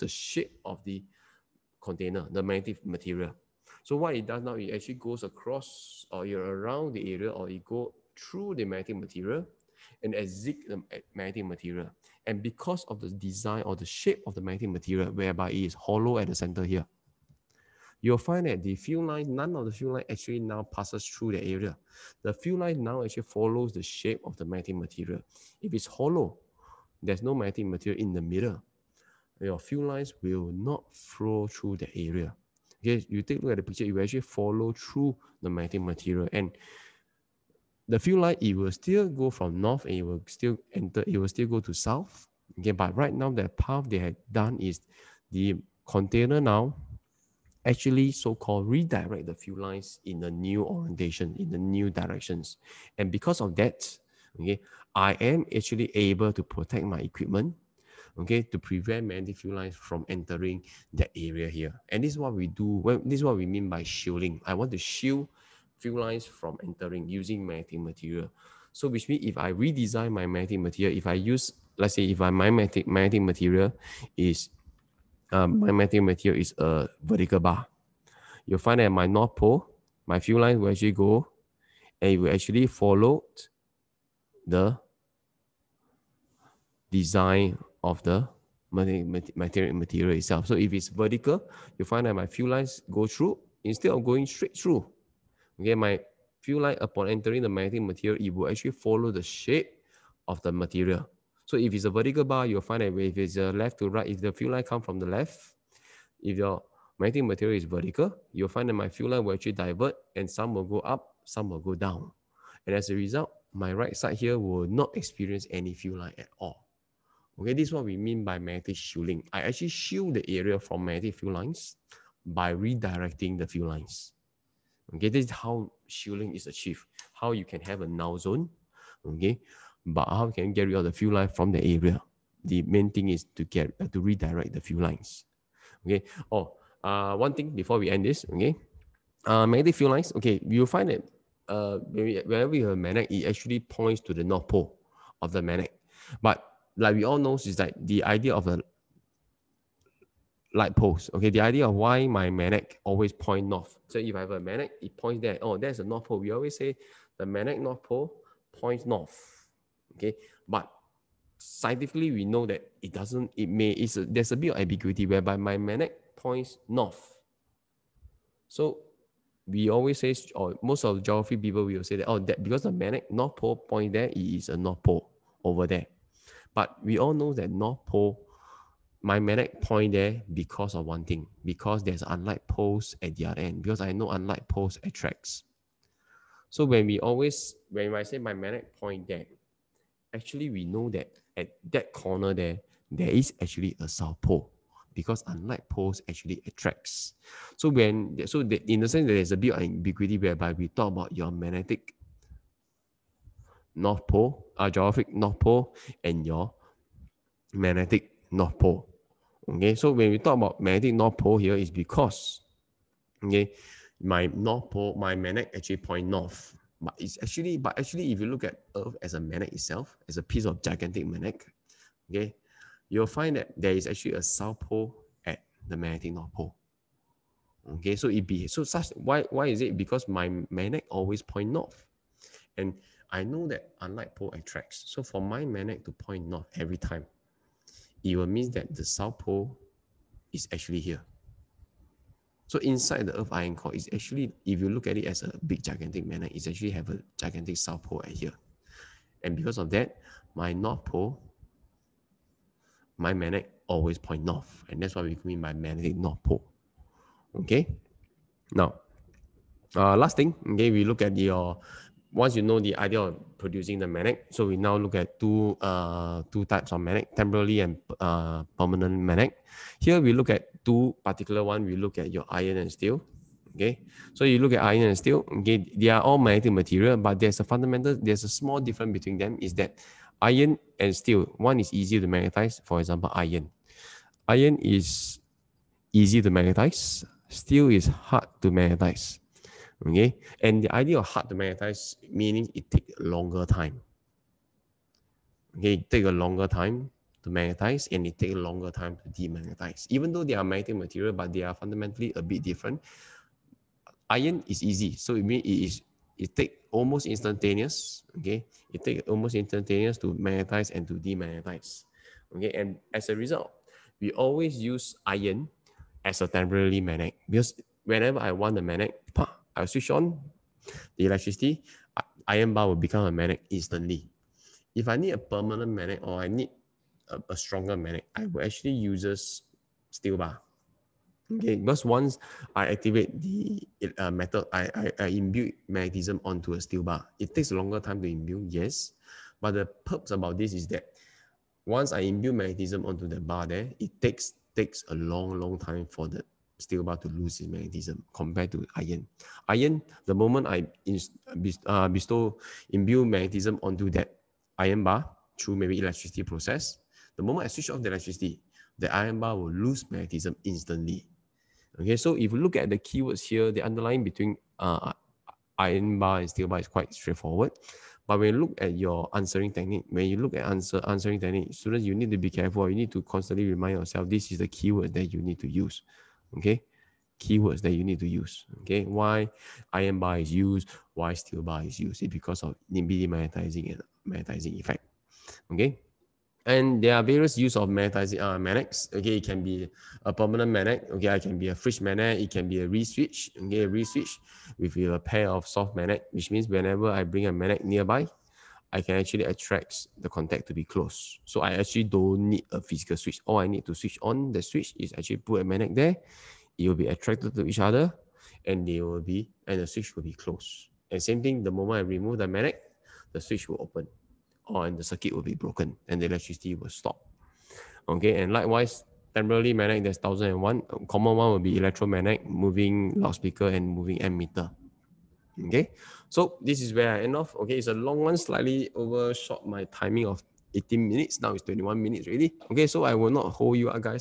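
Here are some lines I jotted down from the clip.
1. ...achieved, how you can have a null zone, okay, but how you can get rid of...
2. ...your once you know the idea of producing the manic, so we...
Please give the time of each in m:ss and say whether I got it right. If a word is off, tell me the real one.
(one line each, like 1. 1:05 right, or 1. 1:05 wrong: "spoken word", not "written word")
1. 2:06 right
2. 4:21 right.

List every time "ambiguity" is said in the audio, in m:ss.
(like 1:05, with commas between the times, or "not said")
2:44, 3:19.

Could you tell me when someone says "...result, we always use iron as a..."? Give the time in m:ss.
5:13.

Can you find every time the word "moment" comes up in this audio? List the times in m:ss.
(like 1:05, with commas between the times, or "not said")
5:50, 5:57, 6:51.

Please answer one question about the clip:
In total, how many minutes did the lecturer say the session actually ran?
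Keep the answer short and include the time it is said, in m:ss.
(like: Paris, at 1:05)
21 minutes, at 7:11.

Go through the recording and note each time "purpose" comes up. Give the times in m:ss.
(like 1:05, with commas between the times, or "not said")
5:39.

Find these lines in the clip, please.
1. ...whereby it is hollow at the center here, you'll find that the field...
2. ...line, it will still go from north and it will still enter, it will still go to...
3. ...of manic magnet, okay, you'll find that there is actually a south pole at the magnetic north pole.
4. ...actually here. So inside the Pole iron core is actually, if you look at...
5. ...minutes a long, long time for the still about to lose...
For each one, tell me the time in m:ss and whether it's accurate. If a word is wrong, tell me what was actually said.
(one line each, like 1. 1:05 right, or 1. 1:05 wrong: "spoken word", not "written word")
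1. 0:15 right
2. 0:38 right
3. 3:40 wrong: "gigantic", not "manic"
4. 4:00 wrong: "Earth", not "Pole"
5. 5:44 wrong: "takes", not "minutes".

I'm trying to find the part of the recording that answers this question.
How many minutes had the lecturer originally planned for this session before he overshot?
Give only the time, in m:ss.
7:10.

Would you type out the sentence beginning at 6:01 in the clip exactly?
Okay, so if you look at the keywords here, the underlying between uh, iron bar and steel bar is quite straightforward.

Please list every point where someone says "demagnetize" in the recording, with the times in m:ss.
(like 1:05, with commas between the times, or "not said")
4:59, 5:10.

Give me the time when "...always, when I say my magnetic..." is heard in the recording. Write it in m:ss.
3:06.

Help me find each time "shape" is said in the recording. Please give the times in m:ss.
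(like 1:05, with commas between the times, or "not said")
0:00, 0:13, 0:23, 1:39.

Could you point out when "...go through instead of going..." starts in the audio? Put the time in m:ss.
1:32.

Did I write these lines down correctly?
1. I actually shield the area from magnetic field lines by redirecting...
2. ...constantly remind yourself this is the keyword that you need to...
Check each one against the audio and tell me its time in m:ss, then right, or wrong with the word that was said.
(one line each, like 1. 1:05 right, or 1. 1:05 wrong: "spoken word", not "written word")
1. 1:59 right
2. 6:13 right.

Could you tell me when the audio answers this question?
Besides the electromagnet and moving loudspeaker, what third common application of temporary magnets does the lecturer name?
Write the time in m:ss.
7:03.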